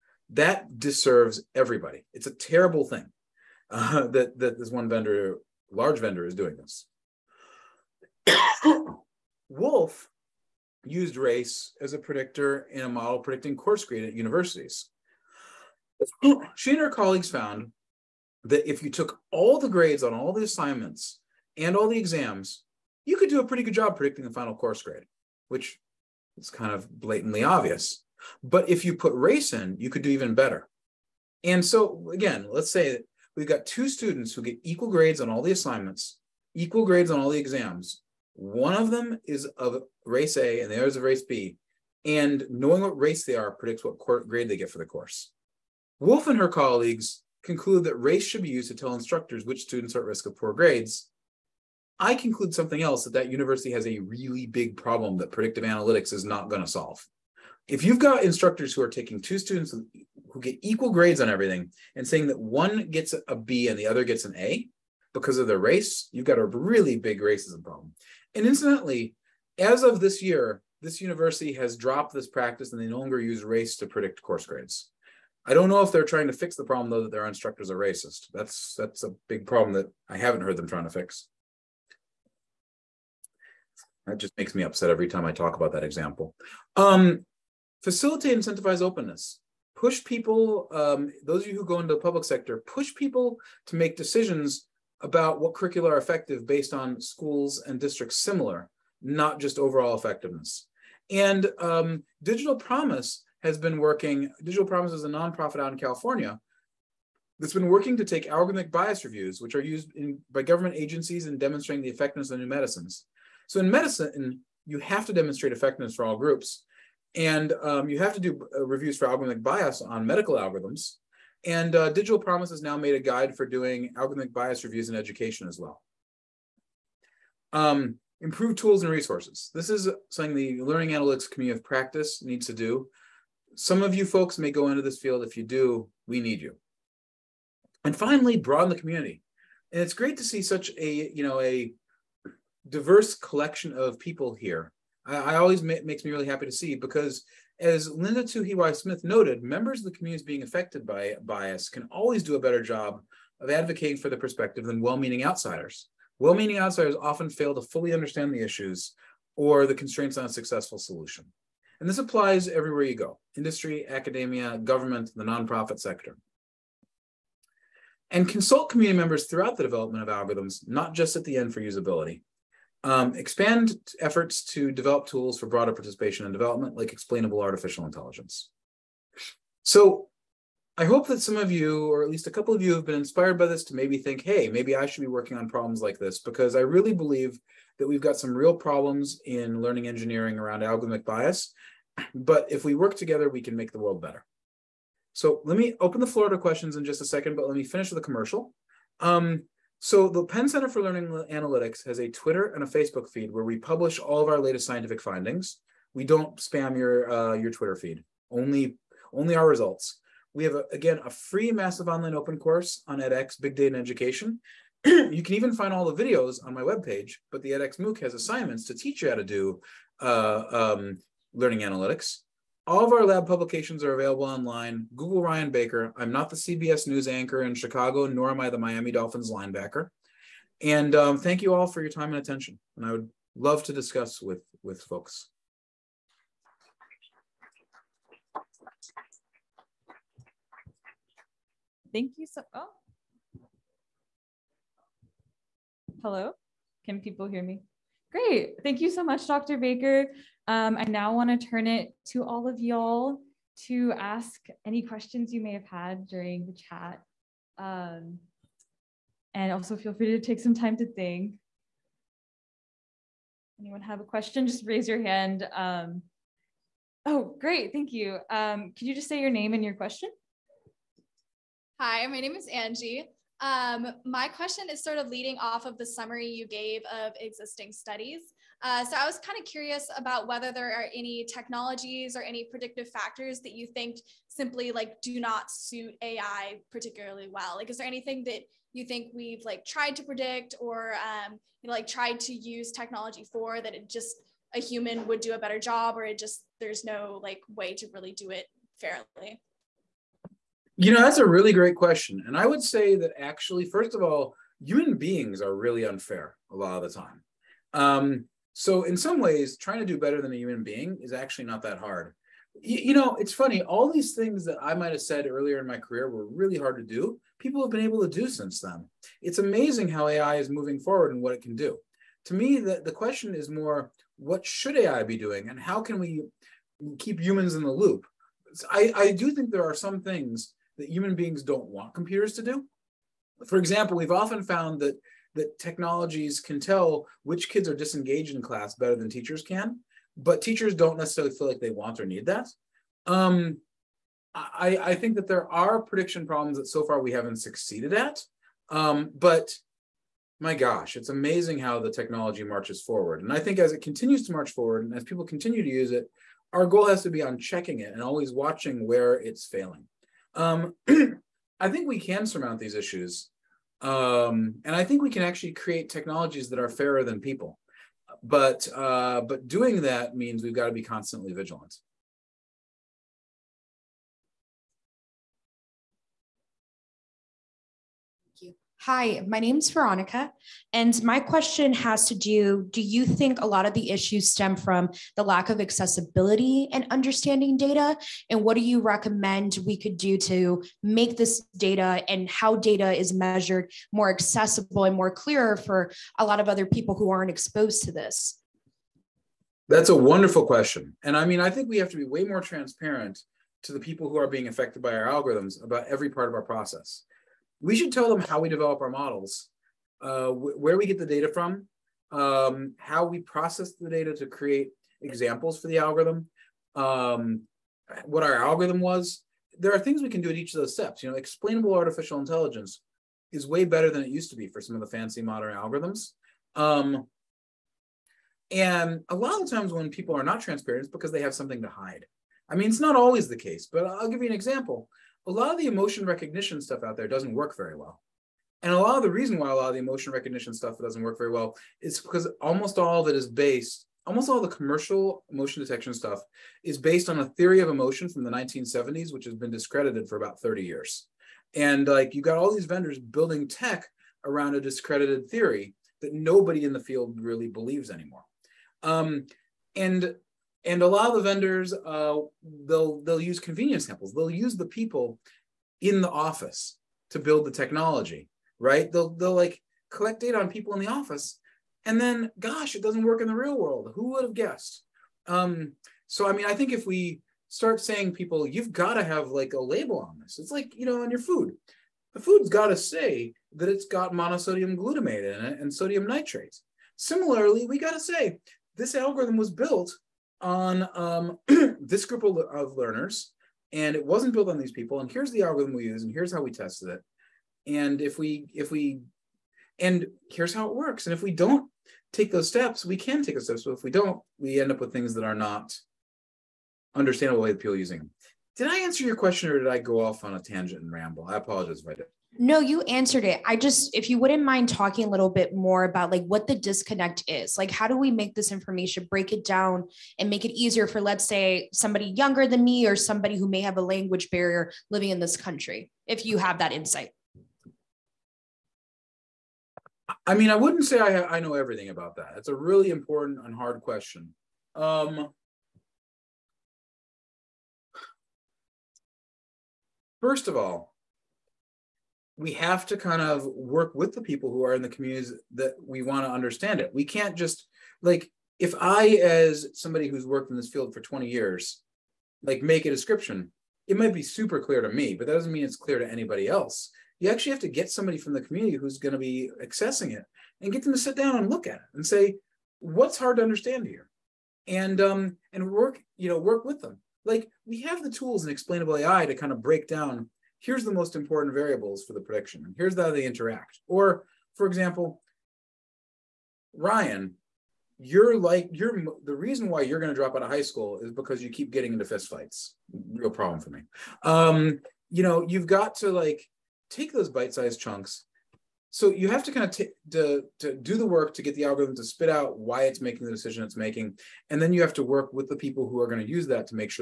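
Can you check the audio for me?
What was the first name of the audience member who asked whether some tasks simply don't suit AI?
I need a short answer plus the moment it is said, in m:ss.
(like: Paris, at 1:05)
Angie, at 4:32.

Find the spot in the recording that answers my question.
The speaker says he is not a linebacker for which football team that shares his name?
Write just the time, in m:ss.
3:48.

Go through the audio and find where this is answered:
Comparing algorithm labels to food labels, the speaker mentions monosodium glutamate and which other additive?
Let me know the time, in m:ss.
8:05.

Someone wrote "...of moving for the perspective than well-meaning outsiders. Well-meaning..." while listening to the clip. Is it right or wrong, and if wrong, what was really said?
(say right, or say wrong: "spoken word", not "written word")
wrong: "advocating", not "moving".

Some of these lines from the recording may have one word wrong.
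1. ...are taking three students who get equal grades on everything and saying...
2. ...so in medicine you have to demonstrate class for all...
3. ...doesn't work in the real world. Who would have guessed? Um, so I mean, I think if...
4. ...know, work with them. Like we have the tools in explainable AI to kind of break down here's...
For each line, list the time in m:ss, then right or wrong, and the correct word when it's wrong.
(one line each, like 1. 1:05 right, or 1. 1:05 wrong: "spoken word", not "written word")
1. 0:58 wrong: "two", not "three"
2. 1:53 wrong: "effectiveness", not "class"
3. 7:52 right
4. 9:26 right.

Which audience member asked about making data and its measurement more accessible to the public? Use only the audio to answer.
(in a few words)
Veronica.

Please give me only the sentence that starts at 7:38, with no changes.
Um, and and a lot of the vendors, uh, they'll they'll use convenience samples.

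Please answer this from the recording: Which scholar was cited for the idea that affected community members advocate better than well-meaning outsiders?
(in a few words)
Linda Tuhiwai Smith.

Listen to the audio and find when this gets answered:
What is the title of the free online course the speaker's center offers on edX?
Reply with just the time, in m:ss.
3:33.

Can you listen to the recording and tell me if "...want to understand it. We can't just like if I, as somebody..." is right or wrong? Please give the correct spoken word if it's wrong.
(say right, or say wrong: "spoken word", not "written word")
right.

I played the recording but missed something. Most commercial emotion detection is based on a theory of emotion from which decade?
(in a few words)
1970s.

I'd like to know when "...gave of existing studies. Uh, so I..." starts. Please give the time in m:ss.
4:36.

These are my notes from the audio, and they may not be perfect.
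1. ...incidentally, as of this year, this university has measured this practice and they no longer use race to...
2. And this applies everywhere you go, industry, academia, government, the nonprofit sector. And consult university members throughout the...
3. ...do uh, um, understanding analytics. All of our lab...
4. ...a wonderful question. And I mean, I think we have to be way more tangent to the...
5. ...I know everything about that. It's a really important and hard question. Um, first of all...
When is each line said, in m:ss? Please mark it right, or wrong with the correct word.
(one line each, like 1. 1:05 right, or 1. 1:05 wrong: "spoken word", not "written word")
1. 1:08 wrong: "dropped", not "measured"
2. 2:41 wrong: "community", not "university"
3. 3:39 wrong: "learning", not "understanding"
4. 6:39 wrong: "transparent", not "tangent"
5. 8:51 right.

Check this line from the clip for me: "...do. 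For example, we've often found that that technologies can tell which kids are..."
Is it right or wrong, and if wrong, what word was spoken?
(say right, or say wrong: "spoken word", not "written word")
right.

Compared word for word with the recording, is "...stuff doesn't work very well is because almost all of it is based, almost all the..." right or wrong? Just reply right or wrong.
right.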